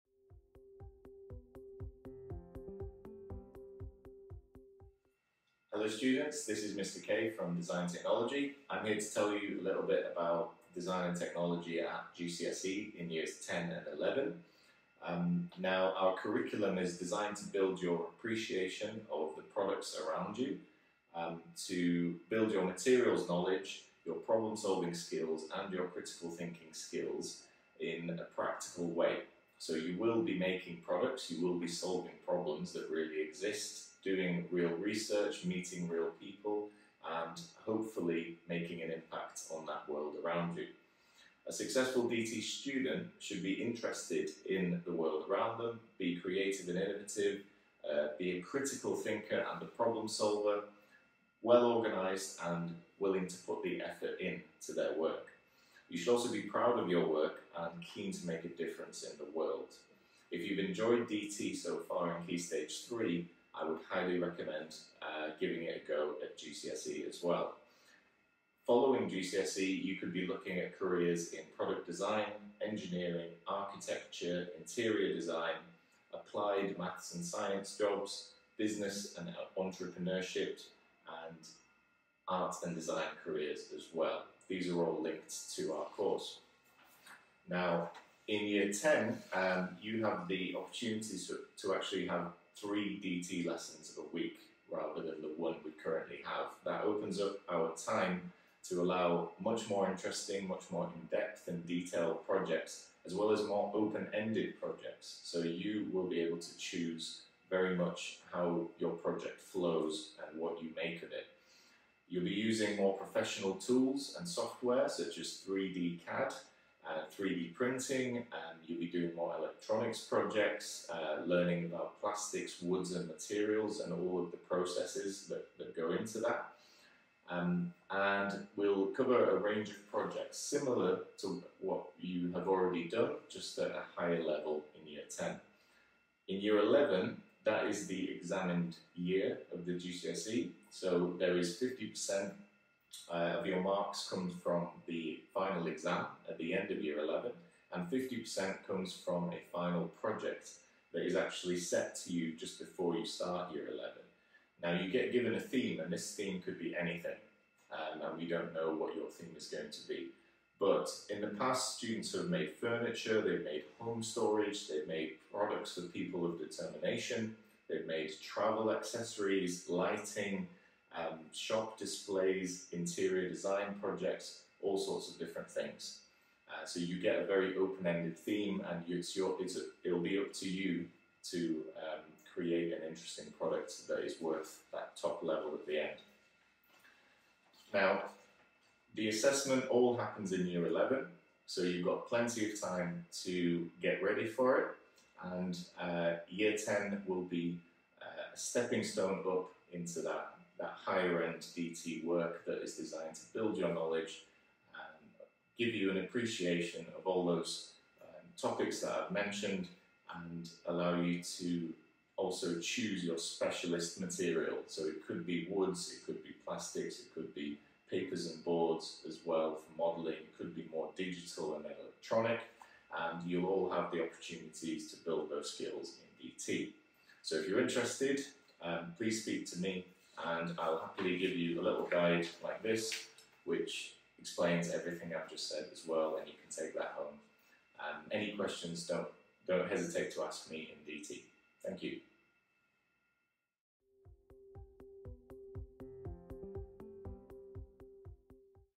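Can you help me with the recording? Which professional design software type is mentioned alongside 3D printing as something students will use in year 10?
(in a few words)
3D CAD.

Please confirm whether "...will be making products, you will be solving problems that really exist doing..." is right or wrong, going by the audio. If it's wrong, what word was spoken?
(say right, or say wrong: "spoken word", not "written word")
right.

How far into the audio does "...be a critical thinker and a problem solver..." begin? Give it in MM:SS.
00:48.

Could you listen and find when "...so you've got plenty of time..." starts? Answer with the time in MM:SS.
03:11.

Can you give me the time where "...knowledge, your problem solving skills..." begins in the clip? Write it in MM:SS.
00:23.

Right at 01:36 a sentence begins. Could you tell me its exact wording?
That opens up our time to allow much more interesting, much more in-depth and detailed projects, as well as more open-ended projects.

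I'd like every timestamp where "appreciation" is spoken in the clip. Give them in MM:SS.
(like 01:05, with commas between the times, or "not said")
00:18, 03:25.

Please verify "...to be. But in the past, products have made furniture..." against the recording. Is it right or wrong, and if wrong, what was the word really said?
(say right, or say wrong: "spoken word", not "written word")
wrong: "students", not "products".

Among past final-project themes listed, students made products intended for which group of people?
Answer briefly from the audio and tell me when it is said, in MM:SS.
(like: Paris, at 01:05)
people of determination, at 02:45.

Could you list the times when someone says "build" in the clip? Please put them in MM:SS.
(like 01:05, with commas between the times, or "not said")
00:17, 00:22, 03:23, 03:45.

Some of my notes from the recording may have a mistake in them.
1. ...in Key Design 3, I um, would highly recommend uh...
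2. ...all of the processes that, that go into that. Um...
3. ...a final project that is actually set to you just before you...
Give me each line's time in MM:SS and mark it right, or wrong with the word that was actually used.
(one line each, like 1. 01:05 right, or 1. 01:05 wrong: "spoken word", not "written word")
1. 01:02 wrong: "Stage", not "Design"
2. 02:03 right
3. 02:29 right.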